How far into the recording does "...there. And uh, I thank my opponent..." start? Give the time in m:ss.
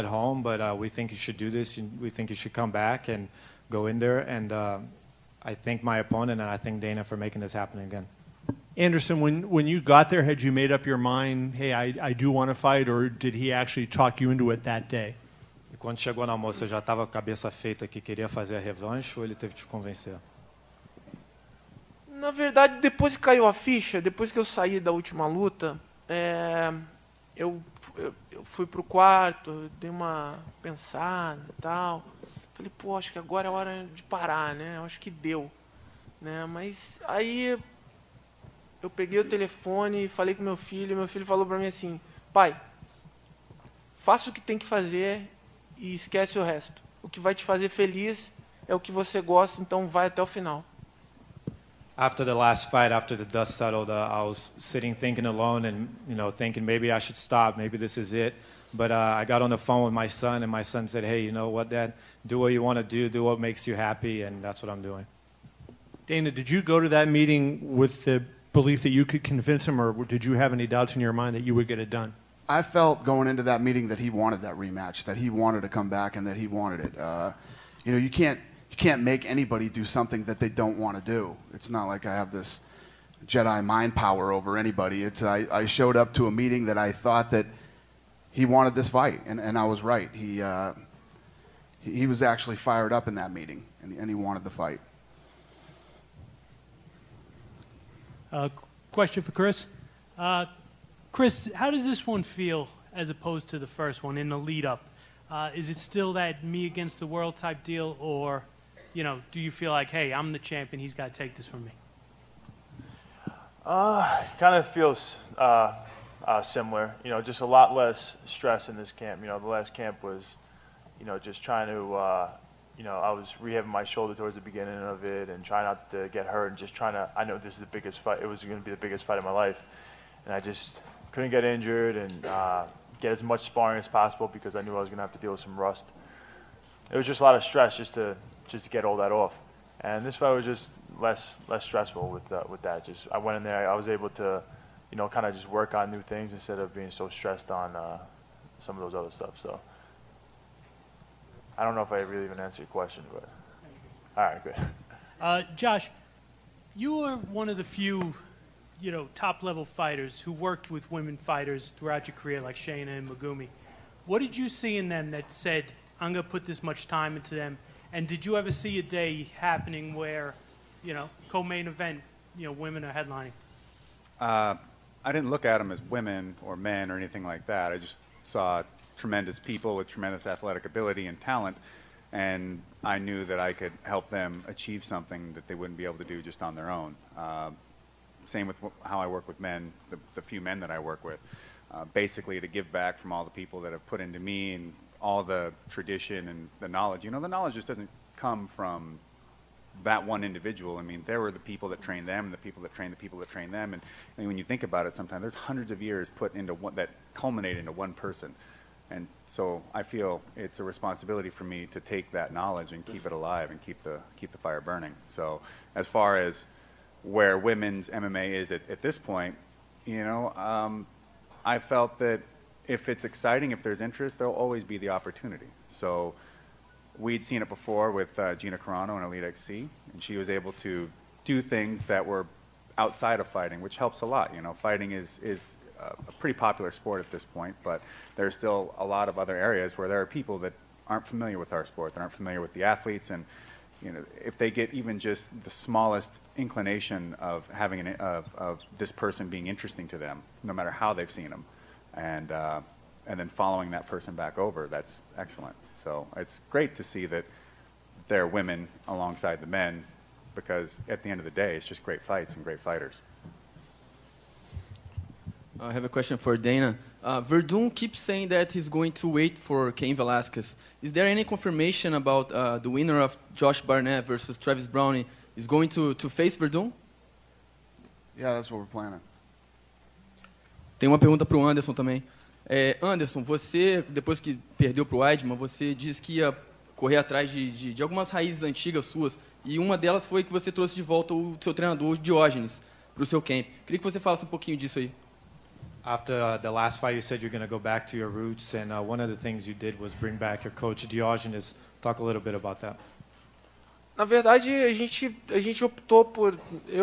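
0:03.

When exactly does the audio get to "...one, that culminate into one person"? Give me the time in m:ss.
3:26.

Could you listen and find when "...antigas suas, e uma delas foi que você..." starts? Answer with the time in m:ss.
4:48.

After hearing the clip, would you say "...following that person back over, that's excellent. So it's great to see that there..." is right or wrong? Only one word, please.
right.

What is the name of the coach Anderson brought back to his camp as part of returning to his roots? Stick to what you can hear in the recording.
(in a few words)
Diogenes.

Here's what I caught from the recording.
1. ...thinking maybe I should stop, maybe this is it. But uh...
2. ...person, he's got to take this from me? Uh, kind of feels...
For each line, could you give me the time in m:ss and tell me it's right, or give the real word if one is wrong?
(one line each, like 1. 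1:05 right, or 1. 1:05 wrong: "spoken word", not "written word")
1. 0:56 right
2. 1:50 wrong: "champion", not "person".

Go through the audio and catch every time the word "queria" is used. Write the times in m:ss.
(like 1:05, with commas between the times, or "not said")
0:17, 4:53.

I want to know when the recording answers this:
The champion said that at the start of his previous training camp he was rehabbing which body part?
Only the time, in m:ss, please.
2:03.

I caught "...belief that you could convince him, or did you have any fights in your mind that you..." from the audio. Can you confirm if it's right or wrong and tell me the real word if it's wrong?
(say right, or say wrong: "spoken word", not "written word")
wrong: "doubts", not "fights".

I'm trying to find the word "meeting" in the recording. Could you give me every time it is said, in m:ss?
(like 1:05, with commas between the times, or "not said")
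1:07, 1:13, 1:26, 1:33.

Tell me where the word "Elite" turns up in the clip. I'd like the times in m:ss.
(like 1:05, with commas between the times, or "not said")
3:49.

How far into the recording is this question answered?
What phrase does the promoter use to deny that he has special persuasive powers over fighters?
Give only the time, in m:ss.
1:23.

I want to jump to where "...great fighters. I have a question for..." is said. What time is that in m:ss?
4:22.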